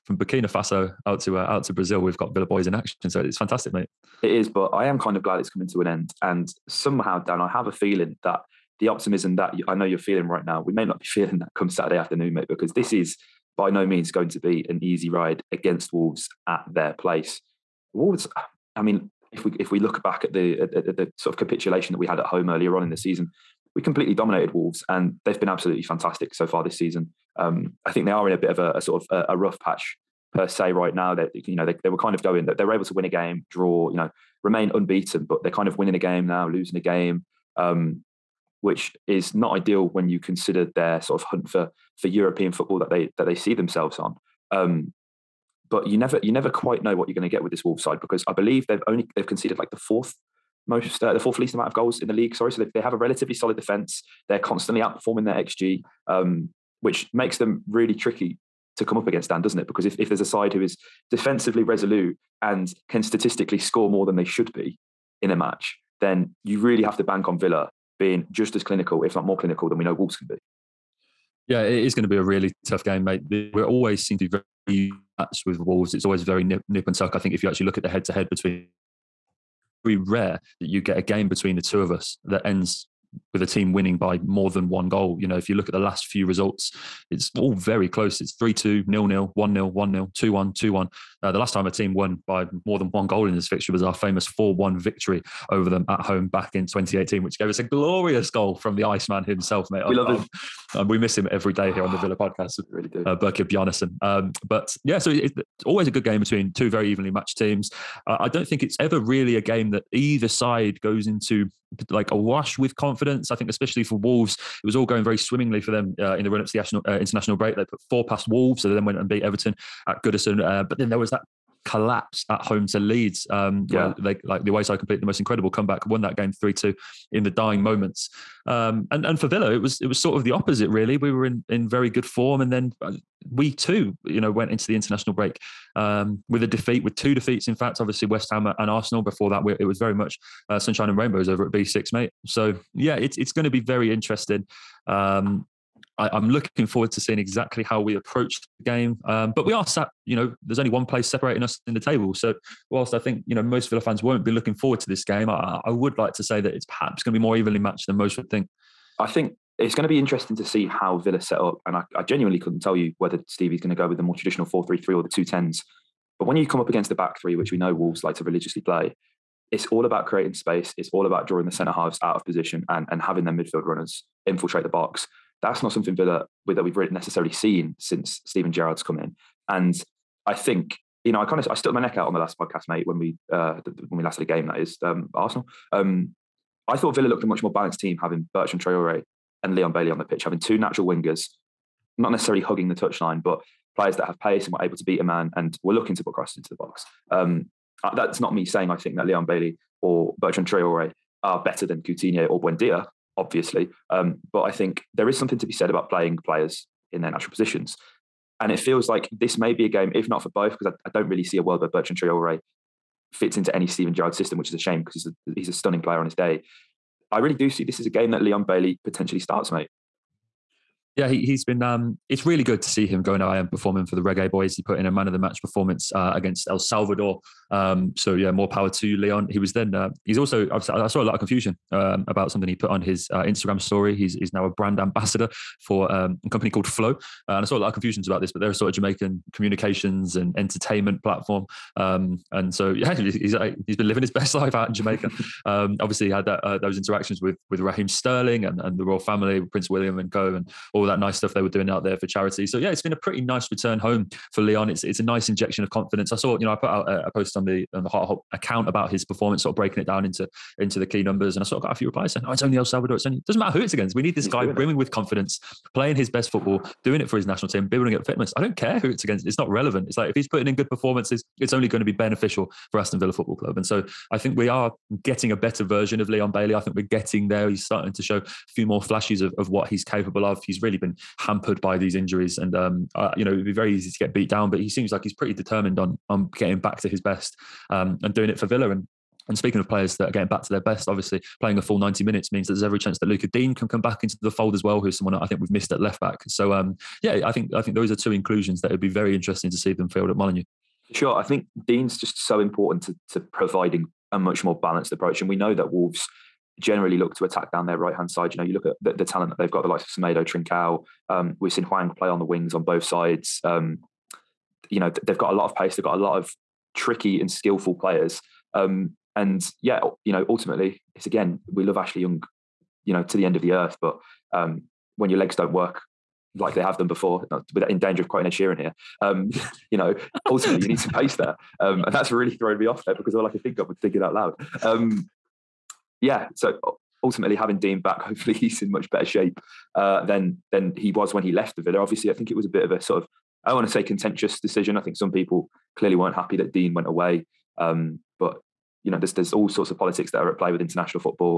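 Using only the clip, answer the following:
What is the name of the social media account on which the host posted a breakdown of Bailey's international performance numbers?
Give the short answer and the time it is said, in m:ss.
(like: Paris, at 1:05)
Heart of Holte, at 4:17.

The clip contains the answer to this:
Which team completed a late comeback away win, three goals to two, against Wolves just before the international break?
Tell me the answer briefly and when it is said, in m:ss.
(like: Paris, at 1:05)
Leeds, at 2:02.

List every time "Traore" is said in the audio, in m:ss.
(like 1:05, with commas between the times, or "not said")
3:08, 3:20, 3:31.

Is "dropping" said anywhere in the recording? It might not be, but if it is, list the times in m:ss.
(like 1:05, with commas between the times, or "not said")
not said.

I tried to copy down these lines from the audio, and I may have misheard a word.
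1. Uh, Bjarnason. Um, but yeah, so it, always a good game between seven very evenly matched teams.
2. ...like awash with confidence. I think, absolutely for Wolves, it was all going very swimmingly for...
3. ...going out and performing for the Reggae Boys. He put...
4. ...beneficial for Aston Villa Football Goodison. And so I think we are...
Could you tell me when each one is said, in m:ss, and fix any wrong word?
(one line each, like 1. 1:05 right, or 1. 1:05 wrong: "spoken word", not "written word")
1. 1:43 wrong: "two", not "seven"
2. 1:51 wrong: "especially", not "absolutely"
3. 3:43 right
4. 4:31 wrong: "Club", not "Goodison".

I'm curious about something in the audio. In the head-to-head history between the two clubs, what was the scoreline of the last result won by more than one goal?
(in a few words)
4-1.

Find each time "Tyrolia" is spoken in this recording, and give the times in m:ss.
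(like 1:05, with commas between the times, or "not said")
not said.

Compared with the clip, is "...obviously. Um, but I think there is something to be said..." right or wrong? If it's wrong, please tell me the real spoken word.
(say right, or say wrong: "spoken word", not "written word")
right.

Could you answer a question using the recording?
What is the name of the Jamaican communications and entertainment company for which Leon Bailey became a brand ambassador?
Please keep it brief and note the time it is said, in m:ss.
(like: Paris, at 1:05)
Flow, at 3:56.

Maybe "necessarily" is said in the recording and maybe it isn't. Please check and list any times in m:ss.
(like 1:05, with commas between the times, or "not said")
2:56, 3:12.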